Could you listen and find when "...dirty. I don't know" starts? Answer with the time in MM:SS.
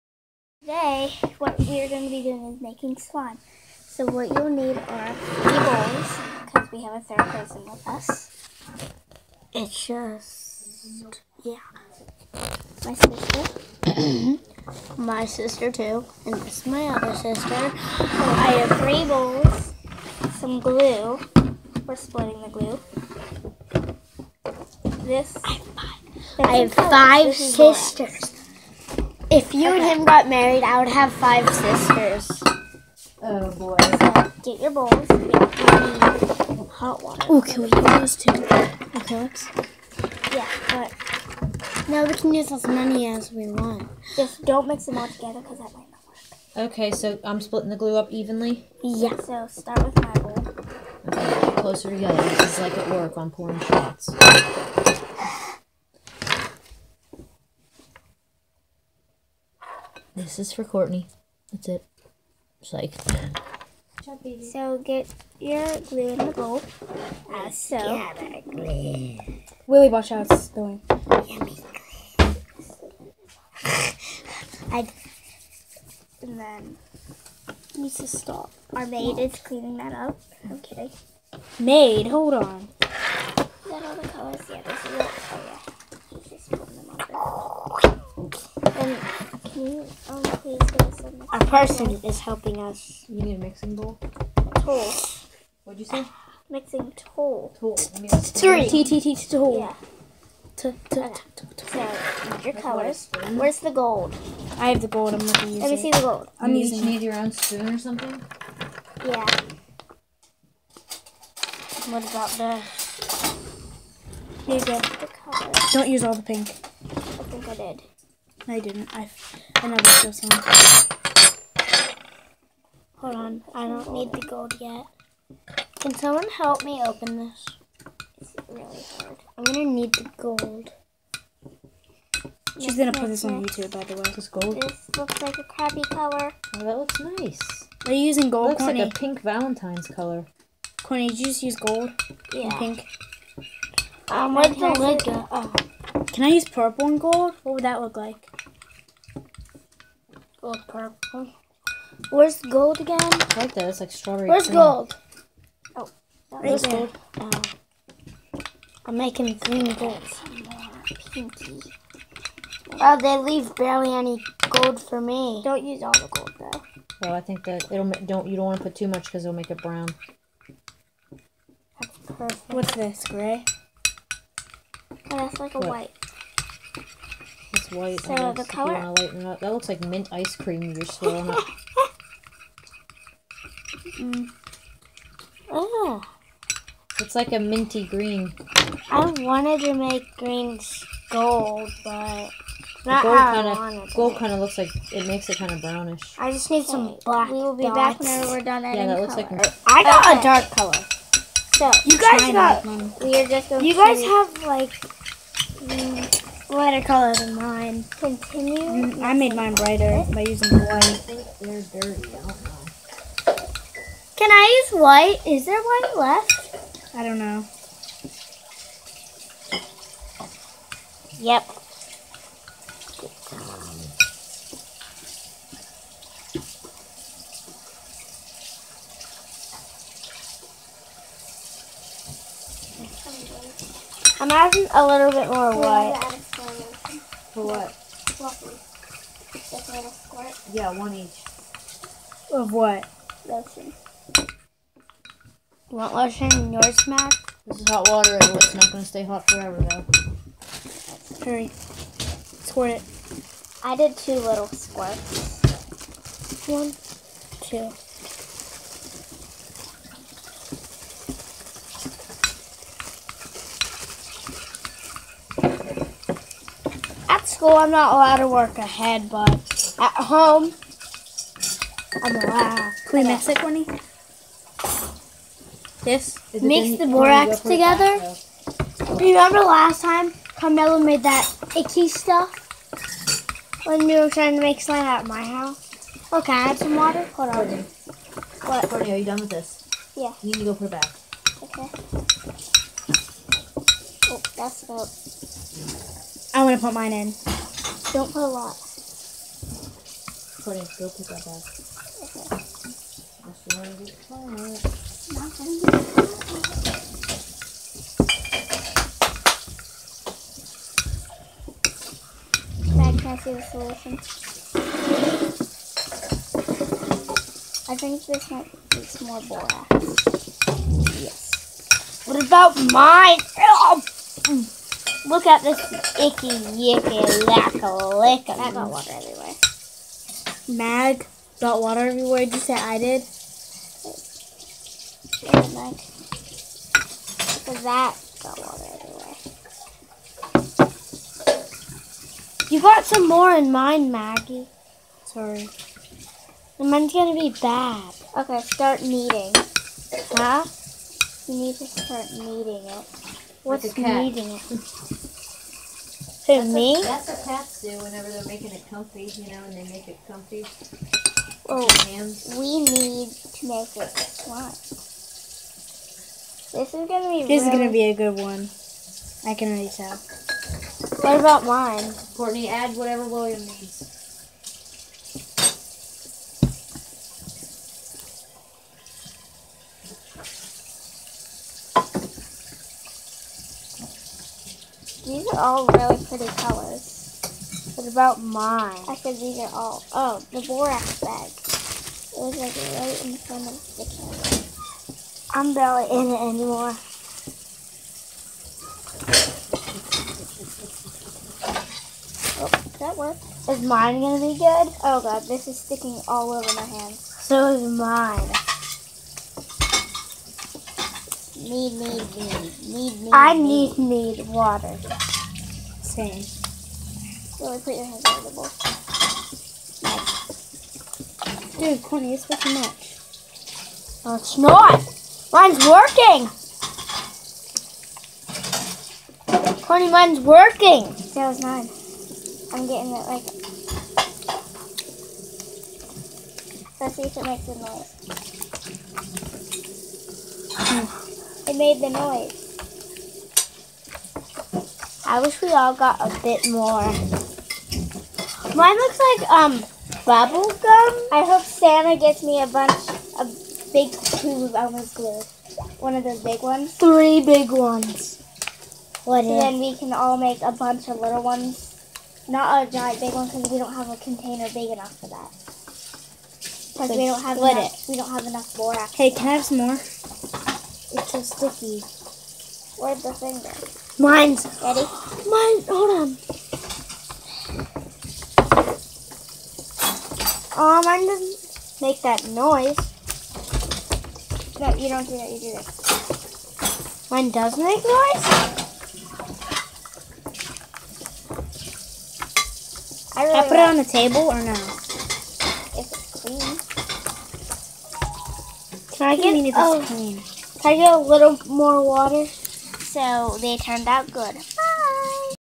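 03:31.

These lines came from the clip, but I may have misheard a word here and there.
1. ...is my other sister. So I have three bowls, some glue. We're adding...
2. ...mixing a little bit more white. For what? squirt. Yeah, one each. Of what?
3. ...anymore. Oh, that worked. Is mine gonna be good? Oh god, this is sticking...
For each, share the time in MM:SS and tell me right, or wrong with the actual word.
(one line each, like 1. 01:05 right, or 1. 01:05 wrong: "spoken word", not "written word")
1. 00:16 wrong: "splitting", not "adding"
2. 03:54 wrong: "adding", not "mixing"
3. 06:36 right.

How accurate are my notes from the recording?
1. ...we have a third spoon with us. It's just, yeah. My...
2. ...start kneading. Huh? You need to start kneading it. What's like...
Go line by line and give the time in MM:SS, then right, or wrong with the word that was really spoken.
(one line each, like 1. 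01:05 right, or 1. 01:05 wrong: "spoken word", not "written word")
1. 00:06 wrong: "person", not "spoon"
2. 05:48 right.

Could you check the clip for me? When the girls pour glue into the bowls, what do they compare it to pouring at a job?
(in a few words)
Shots.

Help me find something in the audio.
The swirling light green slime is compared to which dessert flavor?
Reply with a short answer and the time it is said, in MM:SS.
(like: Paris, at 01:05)
Mint ice cream, at 02:59.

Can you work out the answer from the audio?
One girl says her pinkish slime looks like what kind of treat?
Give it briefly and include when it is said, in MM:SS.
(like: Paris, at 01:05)
Bubble gum, at 07:30.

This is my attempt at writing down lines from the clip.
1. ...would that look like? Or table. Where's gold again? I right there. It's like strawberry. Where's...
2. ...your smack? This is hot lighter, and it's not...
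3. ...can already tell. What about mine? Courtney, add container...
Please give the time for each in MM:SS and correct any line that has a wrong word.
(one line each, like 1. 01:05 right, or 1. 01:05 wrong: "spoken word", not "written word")
1. 02:27 wrong: "purple", not "table"
2. 04:06 wrong: "water", not "lighter"
3. 06:09 wrong: "whatever", not "container".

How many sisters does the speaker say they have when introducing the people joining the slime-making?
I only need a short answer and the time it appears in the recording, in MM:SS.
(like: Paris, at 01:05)
5, at 00:26.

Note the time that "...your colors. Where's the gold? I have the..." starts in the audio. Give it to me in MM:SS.
01:42.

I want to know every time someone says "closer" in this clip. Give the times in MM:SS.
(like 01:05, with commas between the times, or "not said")
00:51.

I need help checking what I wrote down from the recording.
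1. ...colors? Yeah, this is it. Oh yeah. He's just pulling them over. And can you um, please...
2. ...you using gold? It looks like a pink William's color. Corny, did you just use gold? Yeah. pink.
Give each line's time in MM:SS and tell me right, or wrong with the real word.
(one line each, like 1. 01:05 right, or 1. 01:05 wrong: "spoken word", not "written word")
1. 01:24 right
2. 02:17 wrong: "Valentine", not "William".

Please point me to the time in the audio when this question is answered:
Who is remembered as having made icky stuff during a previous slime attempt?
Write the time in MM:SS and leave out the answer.
04:40.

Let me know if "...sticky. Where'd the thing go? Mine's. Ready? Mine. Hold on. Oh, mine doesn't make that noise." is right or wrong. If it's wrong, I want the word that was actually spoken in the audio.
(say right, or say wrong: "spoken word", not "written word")
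right.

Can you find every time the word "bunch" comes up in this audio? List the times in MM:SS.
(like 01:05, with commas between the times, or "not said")
07:32, 07:40.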